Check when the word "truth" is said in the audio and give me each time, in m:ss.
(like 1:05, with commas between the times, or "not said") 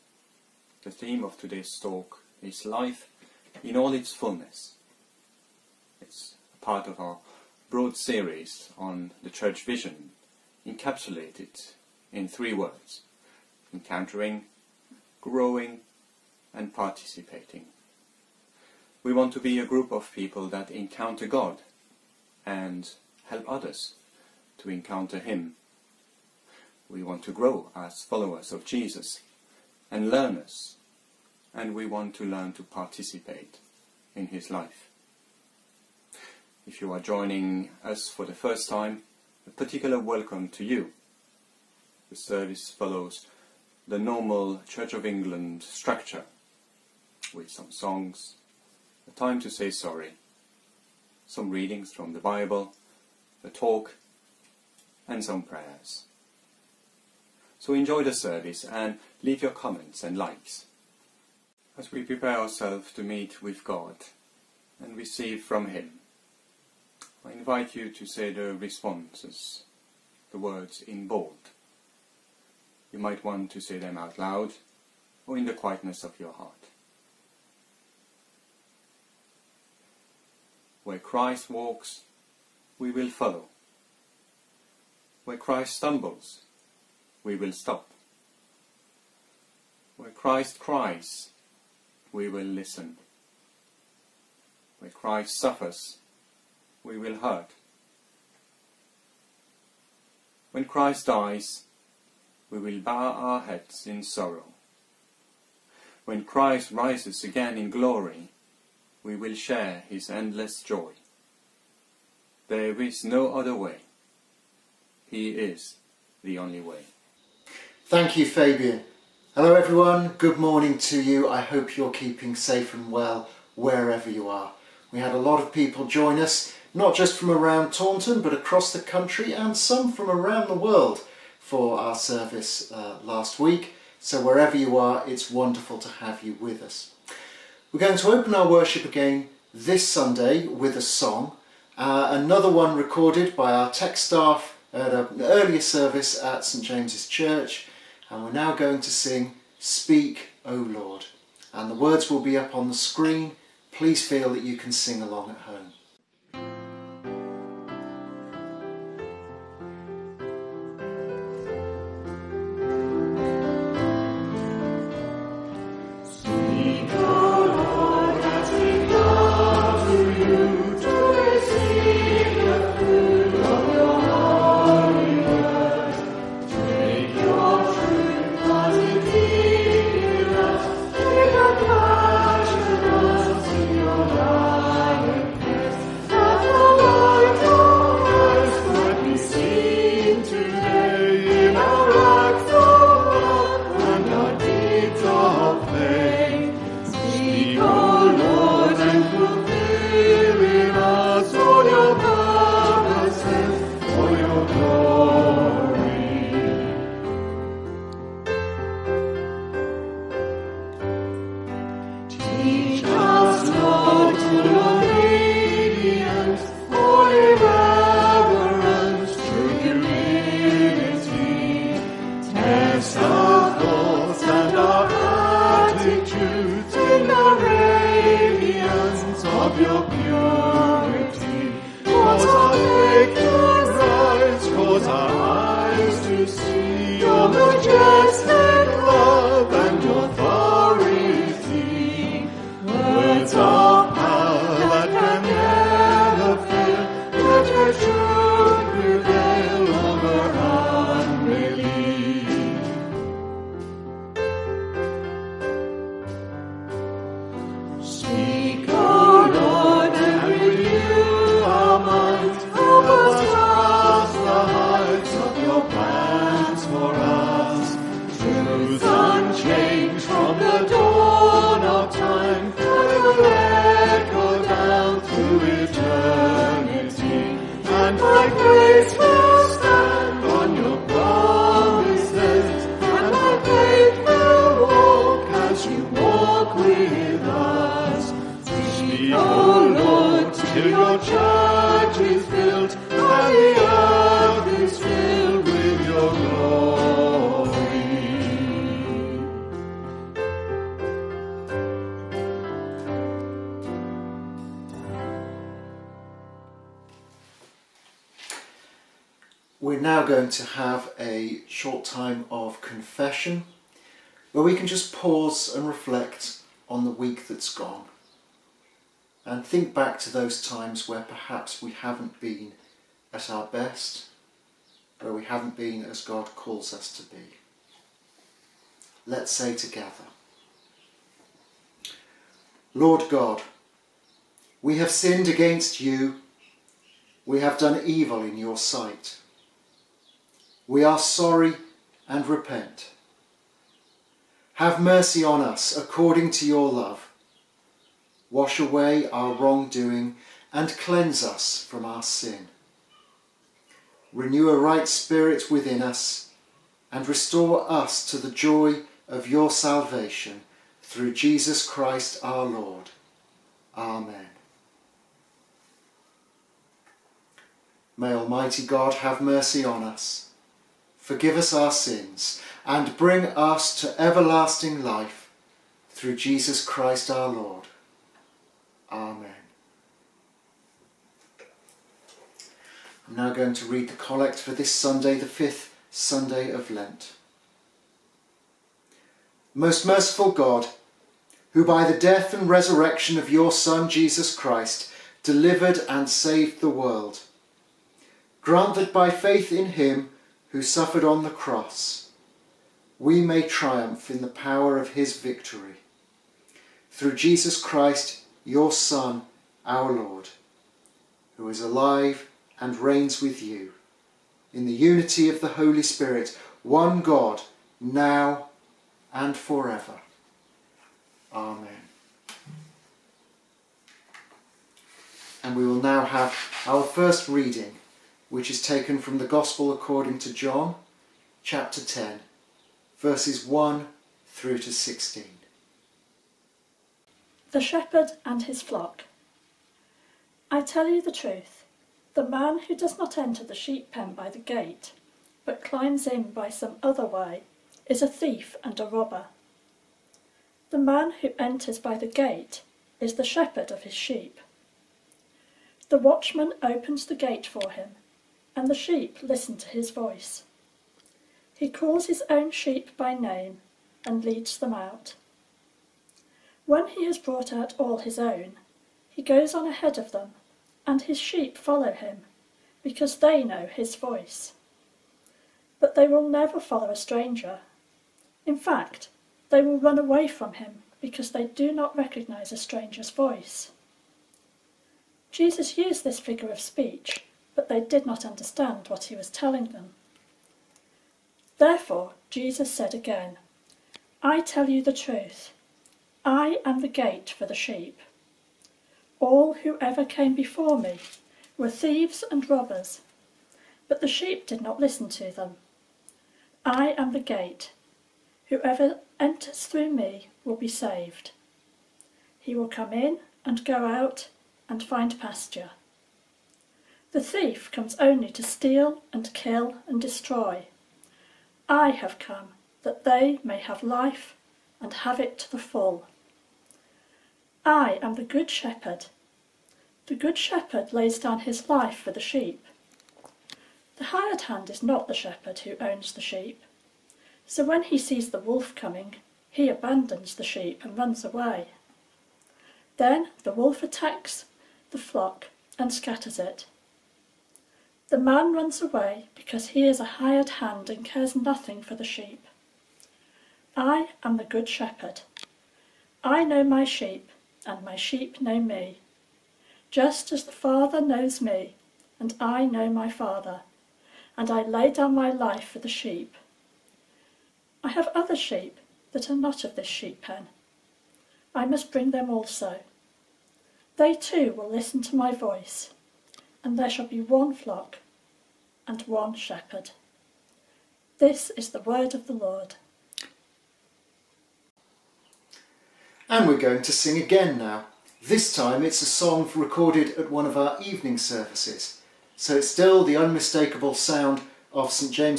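7:21, 8:14.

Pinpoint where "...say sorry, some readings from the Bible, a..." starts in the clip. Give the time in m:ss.
0:49.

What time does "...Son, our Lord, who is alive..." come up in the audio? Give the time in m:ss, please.
6:48.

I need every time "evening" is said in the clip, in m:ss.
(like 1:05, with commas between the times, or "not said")
9:50.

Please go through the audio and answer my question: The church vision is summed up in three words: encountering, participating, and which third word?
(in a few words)
Growing.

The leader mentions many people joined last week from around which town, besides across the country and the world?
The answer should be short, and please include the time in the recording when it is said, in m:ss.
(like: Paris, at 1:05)
Taunton, at 2:07.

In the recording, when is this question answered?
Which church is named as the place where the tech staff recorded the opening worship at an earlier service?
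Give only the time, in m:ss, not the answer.
2:26.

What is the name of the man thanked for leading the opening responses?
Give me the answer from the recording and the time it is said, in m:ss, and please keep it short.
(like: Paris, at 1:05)
Fabian, at 1:58.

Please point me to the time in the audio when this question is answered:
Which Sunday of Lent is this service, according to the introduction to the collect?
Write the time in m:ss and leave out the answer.
6:25.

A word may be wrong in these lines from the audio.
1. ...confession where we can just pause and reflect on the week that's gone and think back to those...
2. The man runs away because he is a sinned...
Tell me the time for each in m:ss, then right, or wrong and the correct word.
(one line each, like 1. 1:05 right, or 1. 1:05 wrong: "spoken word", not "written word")
1. 5:12 right
2. 9:08 wrong: "hired", not "sinned".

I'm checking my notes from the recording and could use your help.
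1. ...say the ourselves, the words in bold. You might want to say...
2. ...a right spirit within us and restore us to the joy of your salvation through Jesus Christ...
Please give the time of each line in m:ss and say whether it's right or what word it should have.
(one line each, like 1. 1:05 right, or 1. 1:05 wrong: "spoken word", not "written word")
1. 1:08 wrong: "responses", not "ourselves"
2. 5:54 right.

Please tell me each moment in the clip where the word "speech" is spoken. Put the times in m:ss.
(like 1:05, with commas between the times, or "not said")
8:06.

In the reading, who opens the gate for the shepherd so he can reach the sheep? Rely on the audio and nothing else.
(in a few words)
The watchman.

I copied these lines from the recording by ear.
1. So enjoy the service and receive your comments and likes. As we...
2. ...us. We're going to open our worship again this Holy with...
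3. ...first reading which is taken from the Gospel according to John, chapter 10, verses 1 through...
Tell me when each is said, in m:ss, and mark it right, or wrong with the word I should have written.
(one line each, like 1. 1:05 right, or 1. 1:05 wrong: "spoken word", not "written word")
1. 0:57 wrong: "leave", not "receive"
2. 2:16 wrong: "Sunday", not "Holy"
3. 7:06 right.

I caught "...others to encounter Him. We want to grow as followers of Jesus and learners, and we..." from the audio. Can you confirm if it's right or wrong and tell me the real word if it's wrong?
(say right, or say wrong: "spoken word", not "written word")
right.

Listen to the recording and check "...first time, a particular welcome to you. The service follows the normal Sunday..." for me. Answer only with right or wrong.
wrong.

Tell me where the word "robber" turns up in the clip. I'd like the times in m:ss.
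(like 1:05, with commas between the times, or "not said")
7:28, 8:22.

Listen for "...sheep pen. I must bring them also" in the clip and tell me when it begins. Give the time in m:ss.
9:29.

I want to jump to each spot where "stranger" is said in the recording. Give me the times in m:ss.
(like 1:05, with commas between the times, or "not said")
7:56, 8:02.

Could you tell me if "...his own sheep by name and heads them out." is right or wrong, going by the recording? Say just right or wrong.
wrong.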